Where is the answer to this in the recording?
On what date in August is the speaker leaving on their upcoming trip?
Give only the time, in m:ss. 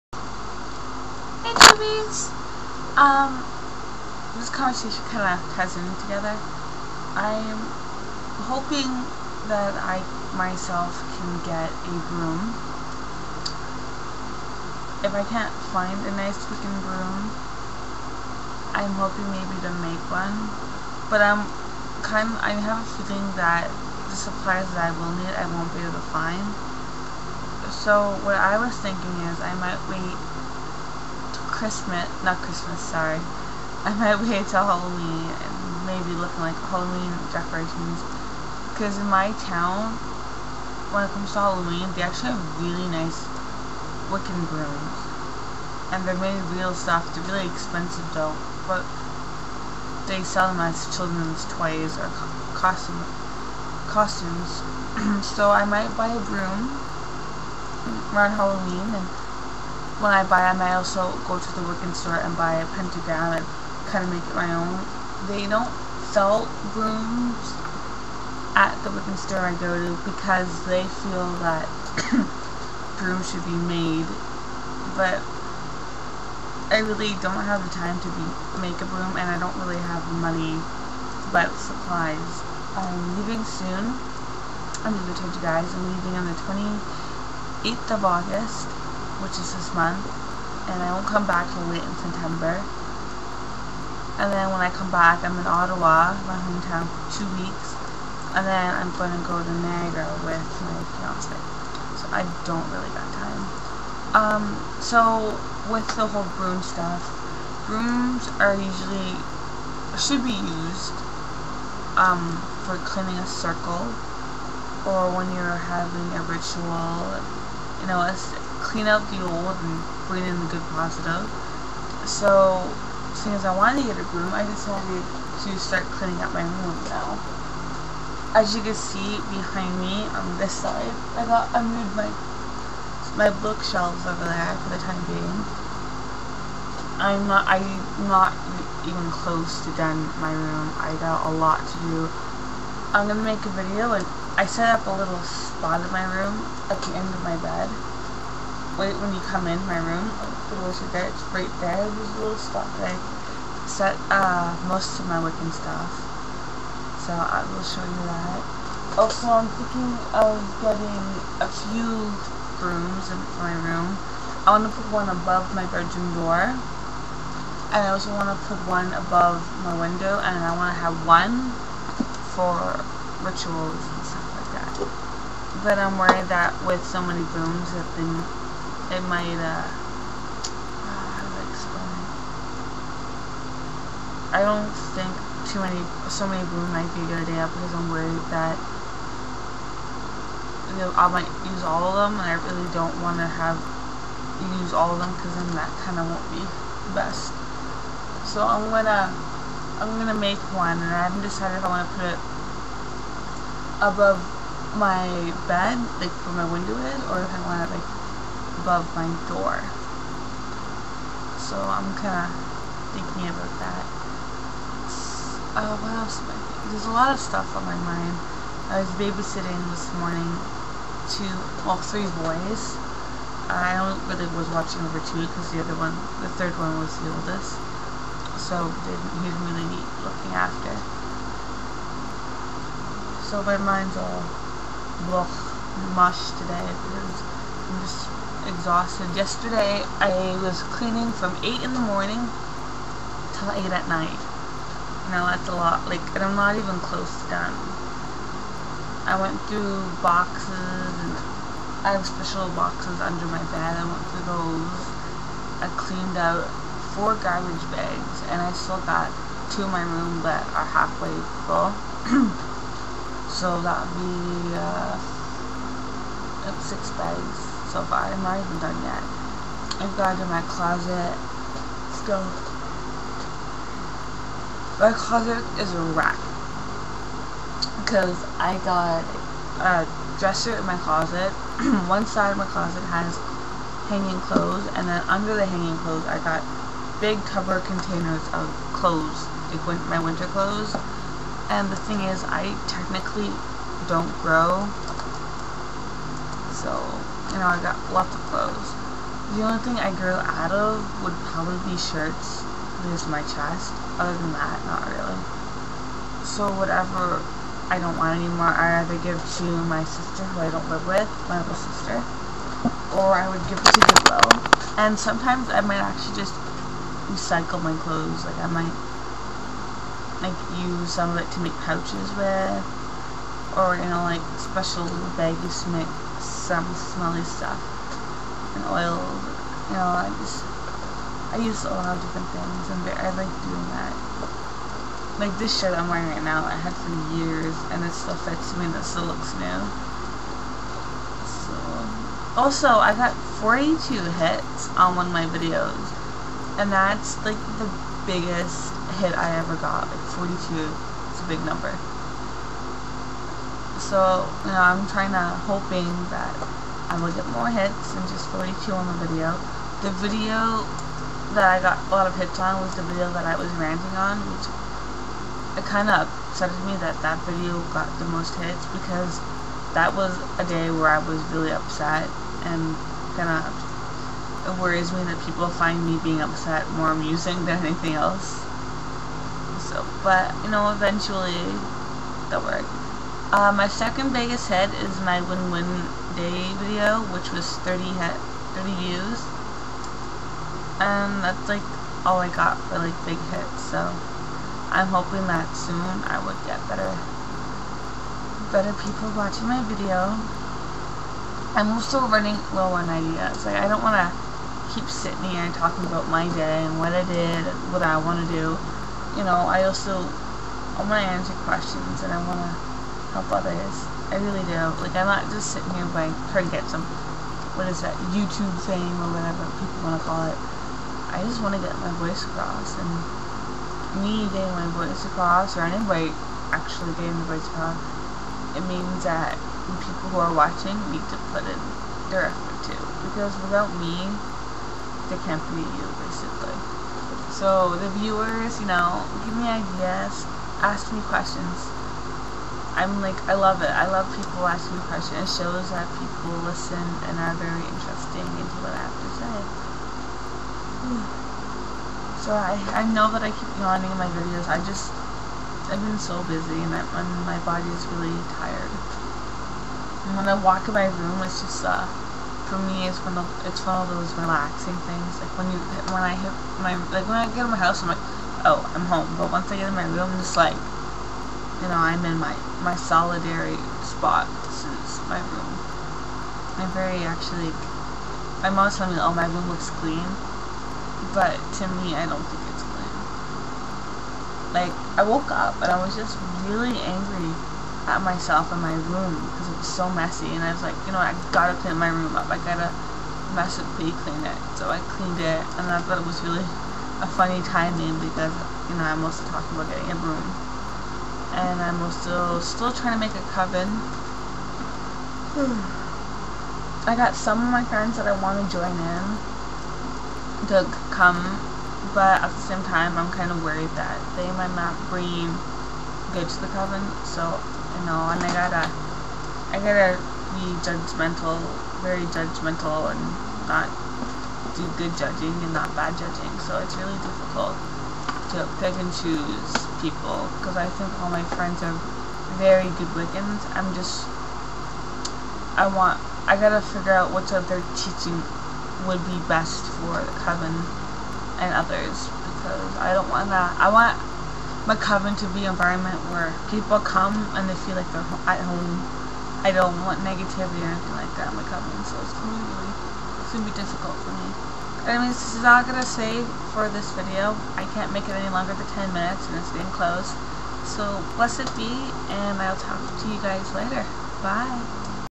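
1:26.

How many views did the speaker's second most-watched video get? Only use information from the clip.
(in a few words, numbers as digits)
30.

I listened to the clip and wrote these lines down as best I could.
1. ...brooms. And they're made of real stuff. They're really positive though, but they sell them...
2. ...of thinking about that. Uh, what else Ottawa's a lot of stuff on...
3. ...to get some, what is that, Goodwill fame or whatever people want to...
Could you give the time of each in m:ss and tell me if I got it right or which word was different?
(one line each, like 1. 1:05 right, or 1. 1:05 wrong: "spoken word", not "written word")
1. 0:44 wrong: "expensive", not "positive"
2. 3:32 wrong: "There", not "Ottawa"
3. 6:56 wrong: "YouTube", not "Goodwill".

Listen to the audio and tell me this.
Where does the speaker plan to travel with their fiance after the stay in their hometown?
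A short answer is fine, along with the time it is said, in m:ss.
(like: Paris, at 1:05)
Niagara, at 1:39.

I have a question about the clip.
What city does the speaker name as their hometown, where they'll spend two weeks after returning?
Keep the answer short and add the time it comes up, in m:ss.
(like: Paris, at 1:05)
Ottawa, at 1:35.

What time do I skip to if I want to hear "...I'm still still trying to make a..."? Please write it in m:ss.
8:21.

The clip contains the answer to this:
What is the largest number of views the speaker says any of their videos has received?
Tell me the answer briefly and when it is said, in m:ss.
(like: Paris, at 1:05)
42, at 5:43.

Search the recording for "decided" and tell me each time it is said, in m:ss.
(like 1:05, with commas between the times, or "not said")
2:04, 3:21.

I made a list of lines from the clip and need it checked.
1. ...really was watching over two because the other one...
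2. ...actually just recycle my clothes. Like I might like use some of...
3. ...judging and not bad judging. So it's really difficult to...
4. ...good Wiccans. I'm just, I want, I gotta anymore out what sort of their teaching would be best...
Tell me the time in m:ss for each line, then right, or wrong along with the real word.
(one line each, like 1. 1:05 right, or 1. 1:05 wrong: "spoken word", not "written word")
1. 3:44 right
2. 5:15 right
3. 8:44 right
4. 8:52 wrong: "figure", not "anymore".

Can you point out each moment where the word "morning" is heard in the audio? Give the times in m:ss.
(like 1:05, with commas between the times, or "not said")
3:40, 4:01.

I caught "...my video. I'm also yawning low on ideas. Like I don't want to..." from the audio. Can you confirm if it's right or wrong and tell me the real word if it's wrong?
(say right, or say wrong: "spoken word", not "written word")
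wrong: "running", not "yawning".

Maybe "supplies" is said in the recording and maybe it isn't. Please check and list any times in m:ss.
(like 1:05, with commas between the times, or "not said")
0:24, 1:21.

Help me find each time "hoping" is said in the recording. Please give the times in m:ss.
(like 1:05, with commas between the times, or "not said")
0:08, 0:18, 5:55, 6:34.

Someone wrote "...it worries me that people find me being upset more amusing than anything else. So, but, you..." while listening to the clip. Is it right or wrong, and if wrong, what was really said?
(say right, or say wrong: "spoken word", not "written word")
right.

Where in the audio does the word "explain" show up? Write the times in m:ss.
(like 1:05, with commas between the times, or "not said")
3:01.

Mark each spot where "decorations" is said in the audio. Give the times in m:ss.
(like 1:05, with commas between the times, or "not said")
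0:37.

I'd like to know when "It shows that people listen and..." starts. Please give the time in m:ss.
7:25.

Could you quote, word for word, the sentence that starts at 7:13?
Because without me, they can't be you, basically.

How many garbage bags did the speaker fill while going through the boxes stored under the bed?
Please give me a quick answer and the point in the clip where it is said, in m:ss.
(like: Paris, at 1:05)
4, at 4:16.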